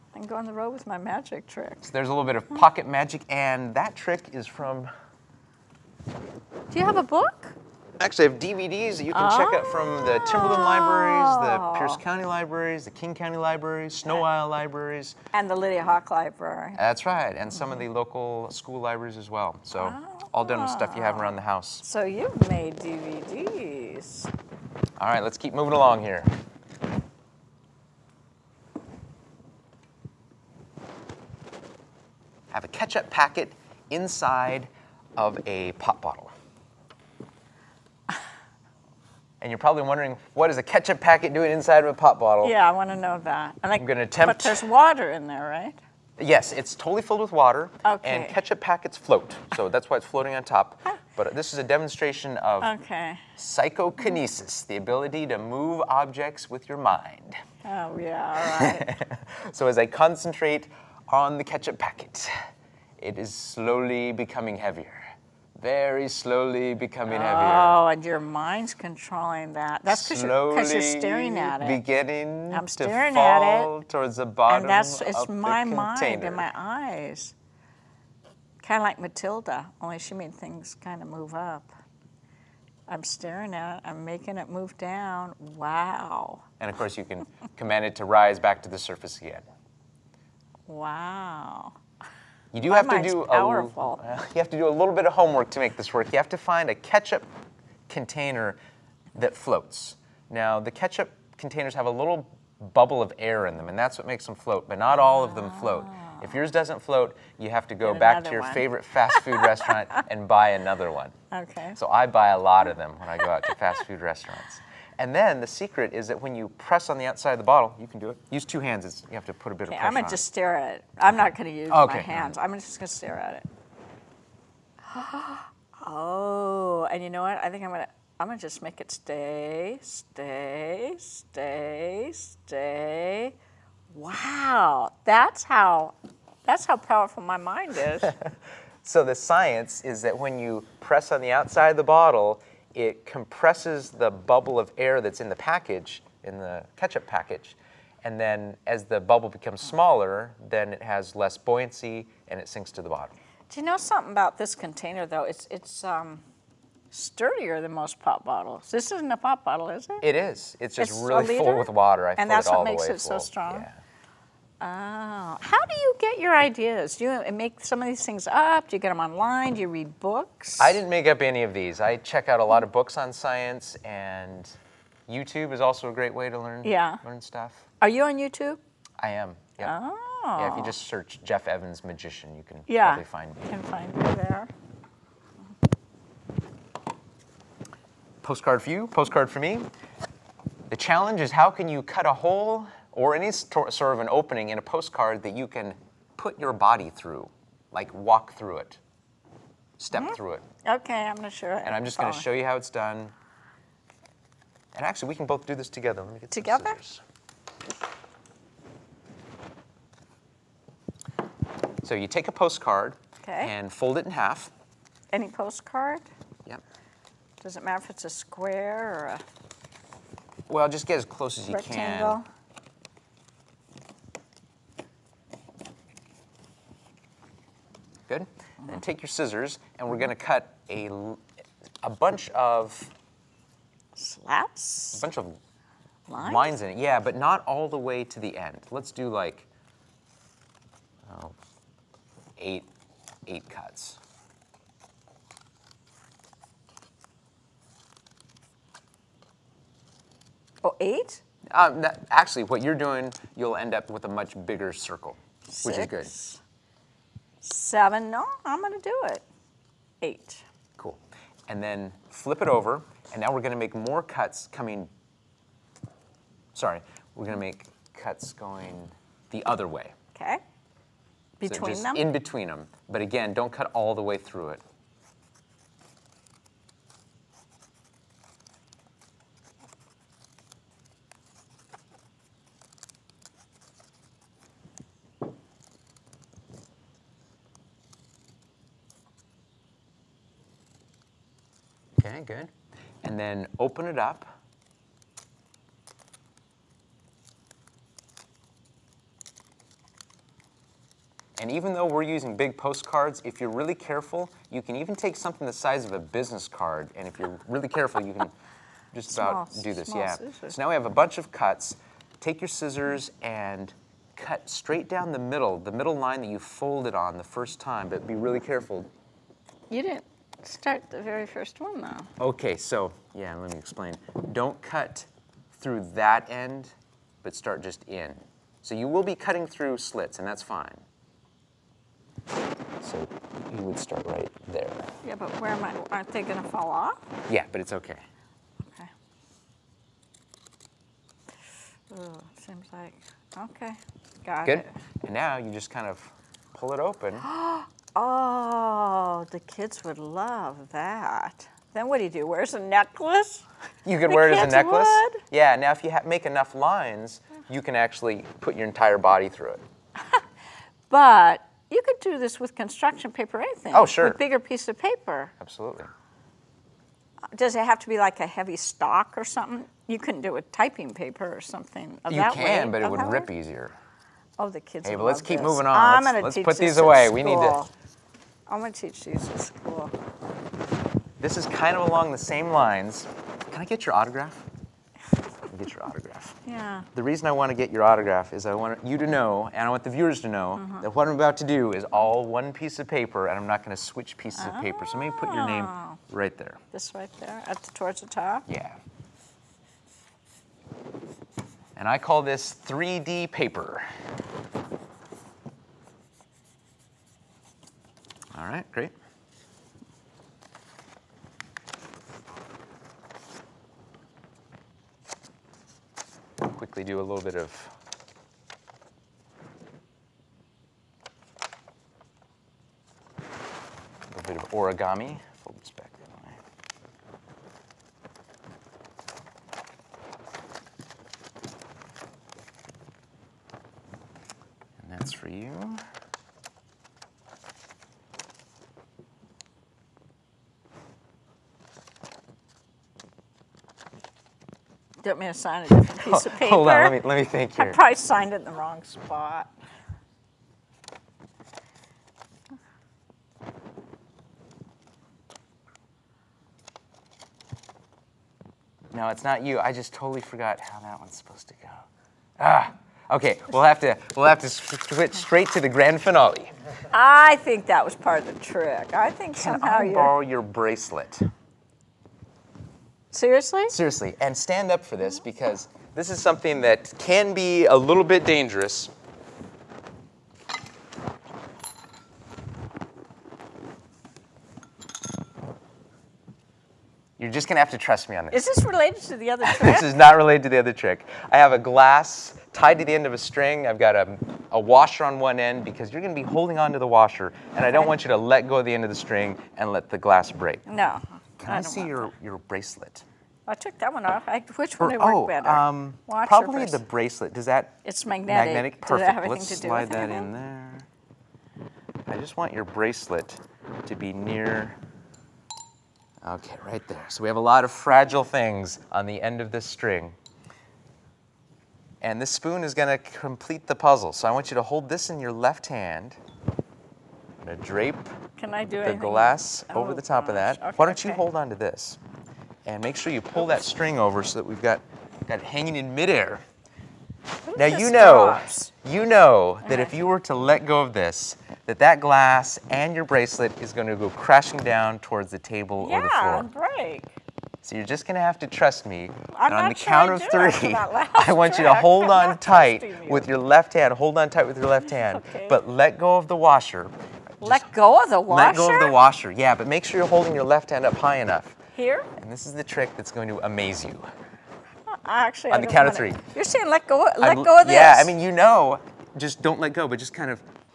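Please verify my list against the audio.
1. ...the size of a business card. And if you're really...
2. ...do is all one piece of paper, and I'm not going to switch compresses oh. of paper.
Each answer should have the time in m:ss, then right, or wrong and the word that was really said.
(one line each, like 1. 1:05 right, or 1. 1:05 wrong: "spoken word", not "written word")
1. 5:05 right
2. 6:31 wrong: "pieces", not "compresses".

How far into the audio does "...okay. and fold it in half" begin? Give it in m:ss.
3:33.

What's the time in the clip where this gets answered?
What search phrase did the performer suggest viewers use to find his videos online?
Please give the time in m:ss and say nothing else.
3:01.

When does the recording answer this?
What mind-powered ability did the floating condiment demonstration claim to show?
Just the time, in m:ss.
0:53.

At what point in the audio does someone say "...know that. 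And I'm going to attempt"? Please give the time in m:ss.
0:42.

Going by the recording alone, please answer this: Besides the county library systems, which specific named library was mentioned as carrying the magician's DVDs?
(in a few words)
Lydia Hawk Library.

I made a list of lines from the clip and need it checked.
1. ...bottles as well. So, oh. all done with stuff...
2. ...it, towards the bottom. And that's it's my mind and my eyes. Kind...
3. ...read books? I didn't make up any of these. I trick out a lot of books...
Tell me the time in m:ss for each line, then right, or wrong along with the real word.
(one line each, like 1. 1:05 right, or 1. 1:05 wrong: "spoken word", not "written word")
1. 0:18 wrong: "libraries", not "bottles"
2. 1:13 right
3. 2:49 wrong: "check", not "trick".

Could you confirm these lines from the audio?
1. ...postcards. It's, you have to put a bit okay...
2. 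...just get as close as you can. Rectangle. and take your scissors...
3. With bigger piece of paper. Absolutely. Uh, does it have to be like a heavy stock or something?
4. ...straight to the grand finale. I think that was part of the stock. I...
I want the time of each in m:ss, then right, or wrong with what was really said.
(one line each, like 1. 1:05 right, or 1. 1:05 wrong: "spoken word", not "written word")
1. 1:58 wrong: "hands", not "postcards"
2. 3:40 right
3. 6:04 right
4. 7:45 wrong: "trick", not "stock".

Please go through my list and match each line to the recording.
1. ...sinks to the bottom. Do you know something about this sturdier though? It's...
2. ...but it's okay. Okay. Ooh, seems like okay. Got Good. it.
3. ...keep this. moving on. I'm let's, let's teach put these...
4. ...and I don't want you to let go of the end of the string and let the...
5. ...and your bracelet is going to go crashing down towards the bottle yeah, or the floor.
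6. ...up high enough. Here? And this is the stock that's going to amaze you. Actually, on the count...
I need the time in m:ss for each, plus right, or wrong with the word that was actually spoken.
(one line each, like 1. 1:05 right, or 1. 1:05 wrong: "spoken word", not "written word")
1. 2:32 wrong: "container", not "sturdier"
2. 5:37 right
3. 6:15 right
4. 8:17 right
5. 9:02 wrong: "table", not "bottle"
6. 9:20 wrong: "trick", not "stock".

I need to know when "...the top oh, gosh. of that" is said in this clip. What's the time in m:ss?
8:49.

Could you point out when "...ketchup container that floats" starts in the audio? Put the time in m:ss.
1:36.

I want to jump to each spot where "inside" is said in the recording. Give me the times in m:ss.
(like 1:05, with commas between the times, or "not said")
0:33, 0:41.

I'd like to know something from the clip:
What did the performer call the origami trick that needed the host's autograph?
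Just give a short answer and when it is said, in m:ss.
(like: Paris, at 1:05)
3D paper, at 6:42.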